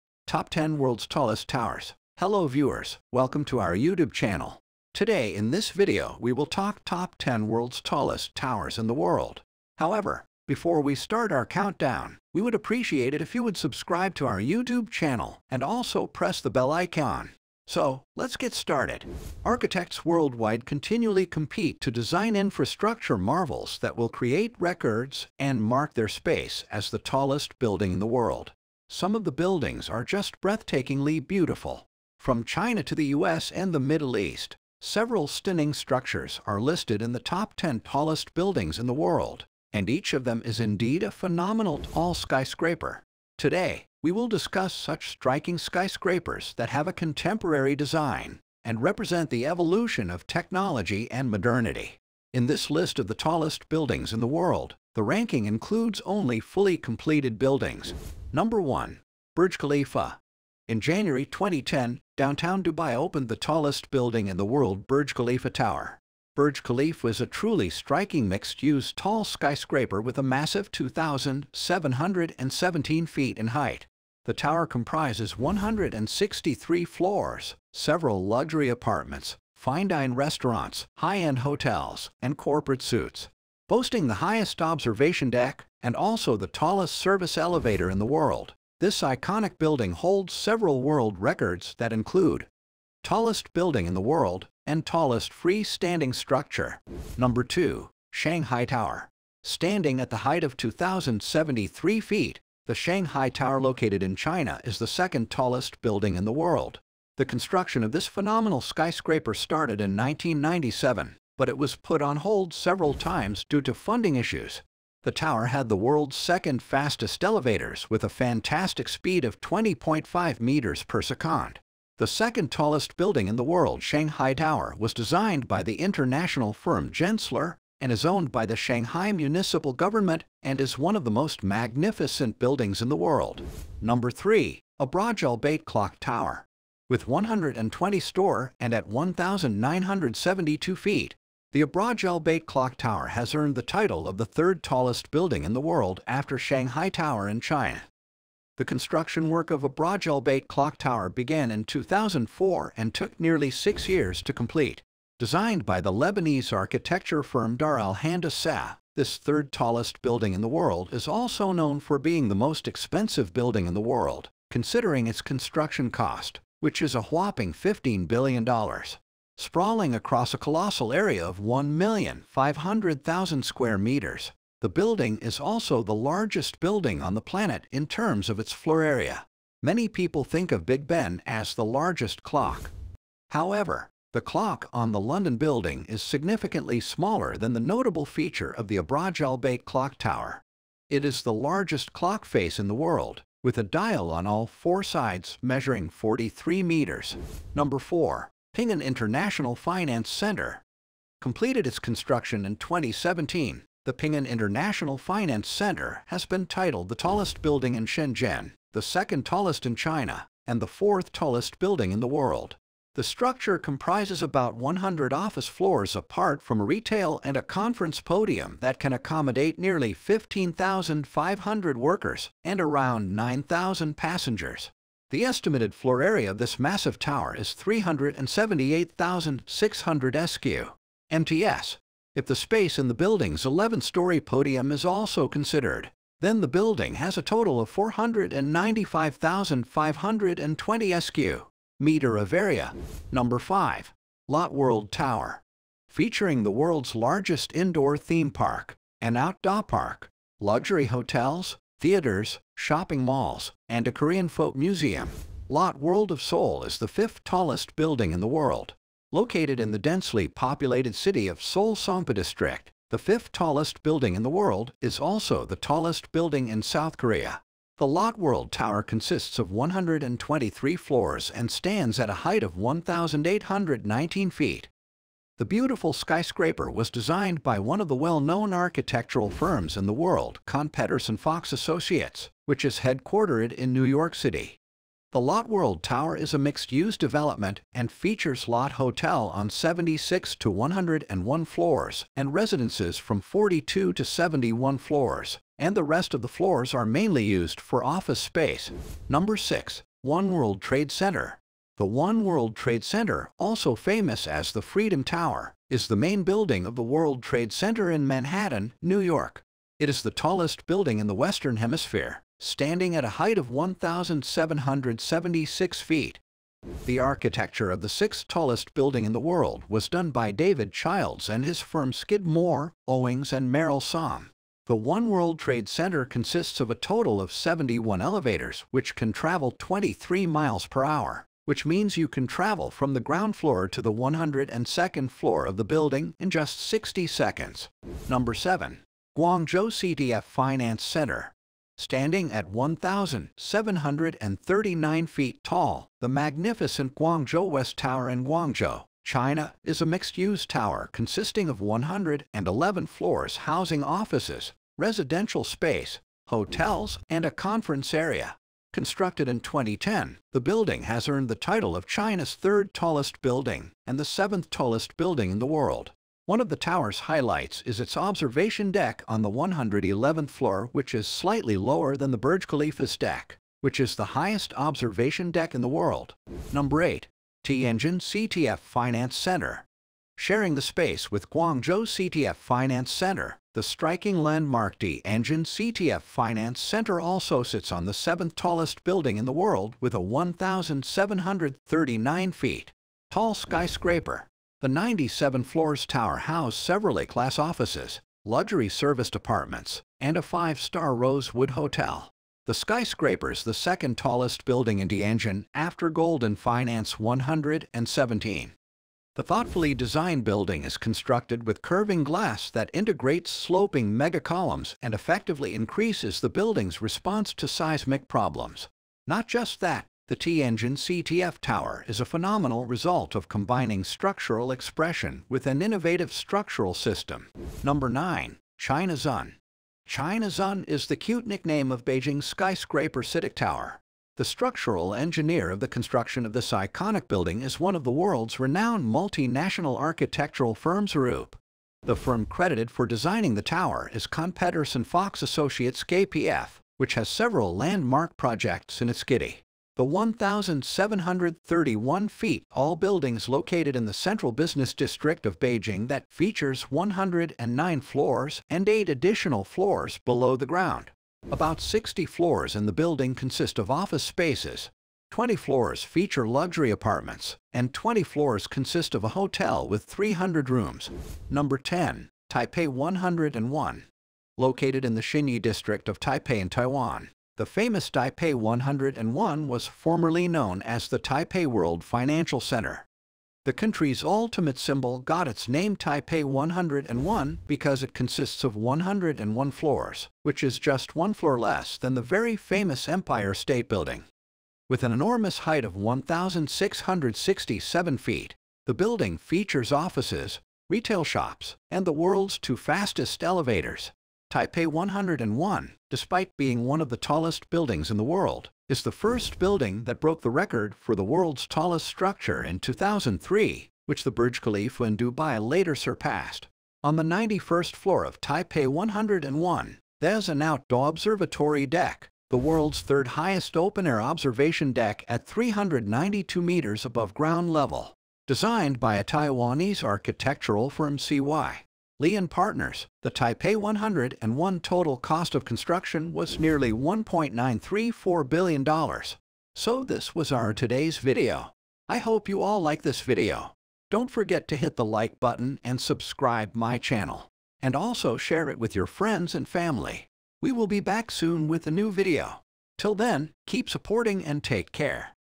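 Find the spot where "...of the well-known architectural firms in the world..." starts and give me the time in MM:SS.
04:37.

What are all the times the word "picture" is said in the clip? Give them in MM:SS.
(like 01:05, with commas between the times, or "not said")
not said.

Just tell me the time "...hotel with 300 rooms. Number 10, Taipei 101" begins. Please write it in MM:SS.
07:49.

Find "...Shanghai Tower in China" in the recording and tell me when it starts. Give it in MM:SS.
02:26.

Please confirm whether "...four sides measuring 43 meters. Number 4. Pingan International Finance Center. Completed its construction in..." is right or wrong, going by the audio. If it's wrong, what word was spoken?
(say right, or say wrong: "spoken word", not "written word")
right.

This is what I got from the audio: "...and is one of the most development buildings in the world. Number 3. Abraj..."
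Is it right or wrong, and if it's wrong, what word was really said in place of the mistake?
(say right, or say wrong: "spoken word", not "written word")
wrong: "magnificent", not "development".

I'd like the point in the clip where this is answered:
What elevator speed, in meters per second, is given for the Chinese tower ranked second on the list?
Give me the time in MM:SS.
01:59.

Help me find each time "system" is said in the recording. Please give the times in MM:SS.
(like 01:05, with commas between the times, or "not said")
07:06.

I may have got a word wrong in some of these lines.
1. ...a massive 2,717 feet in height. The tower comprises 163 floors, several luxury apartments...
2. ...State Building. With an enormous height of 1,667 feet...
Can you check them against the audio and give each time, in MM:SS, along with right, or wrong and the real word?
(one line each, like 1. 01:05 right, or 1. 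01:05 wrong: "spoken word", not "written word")
1. 01:10 right
2. 08:13 right.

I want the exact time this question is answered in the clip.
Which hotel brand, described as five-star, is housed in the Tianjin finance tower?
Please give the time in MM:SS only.
06:40.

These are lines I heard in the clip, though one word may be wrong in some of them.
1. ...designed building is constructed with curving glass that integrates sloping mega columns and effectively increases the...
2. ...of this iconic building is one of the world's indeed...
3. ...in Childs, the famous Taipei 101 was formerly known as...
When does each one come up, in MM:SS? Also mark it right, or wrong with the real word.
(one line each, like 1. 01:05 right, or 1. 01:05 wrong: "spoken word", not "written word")
1. 06:49 right
2. 07:16 wrong: "renowned", not "indeed"
3. 07:56 wrong: "Taiwan", not "Childs".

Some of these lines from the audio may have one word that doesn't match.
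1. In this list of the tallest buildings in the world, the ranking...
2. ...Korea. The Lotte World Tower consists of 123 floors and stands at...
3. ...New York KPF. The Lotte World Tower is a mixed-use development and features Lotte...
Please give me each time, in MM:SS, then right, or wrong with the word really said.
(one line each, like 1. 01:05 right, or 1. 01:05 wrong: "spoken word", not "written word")
1. 00:52 right
2. 04:26 right
3. 04:43 wrong: "City", not "KPF".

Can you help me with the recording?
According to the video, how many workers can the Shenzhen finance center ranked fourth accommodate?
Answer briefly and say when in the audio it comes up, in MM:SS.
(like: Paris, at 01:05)
15,500, at 03:39.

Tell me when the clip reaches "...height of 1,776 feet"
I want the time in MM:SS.
05:13.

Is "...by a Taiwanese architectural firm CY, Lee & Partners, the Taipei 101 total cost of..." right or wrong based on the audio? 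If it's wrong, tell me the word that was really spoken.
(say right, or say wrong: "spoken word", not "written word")
right.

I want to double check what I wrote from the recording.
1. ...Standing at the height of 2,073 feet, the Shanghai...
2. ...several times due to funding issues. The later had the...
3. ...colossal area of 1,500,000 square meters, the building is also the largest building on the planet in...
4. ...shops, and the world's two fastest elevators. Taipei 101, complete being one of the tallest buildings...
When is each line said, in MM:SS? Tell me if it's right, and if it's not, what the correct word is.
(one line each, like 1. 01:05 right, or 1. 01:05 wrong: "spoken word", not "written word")
1. 01:39 right
2. 01:52 wrong: "tower", not "later"
3. 02:50 right
4. 08:21 wrong: "despite", not "complete".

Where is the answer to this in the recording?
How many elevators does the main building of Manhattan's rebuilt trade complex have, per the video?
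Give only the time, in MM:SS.
05:27.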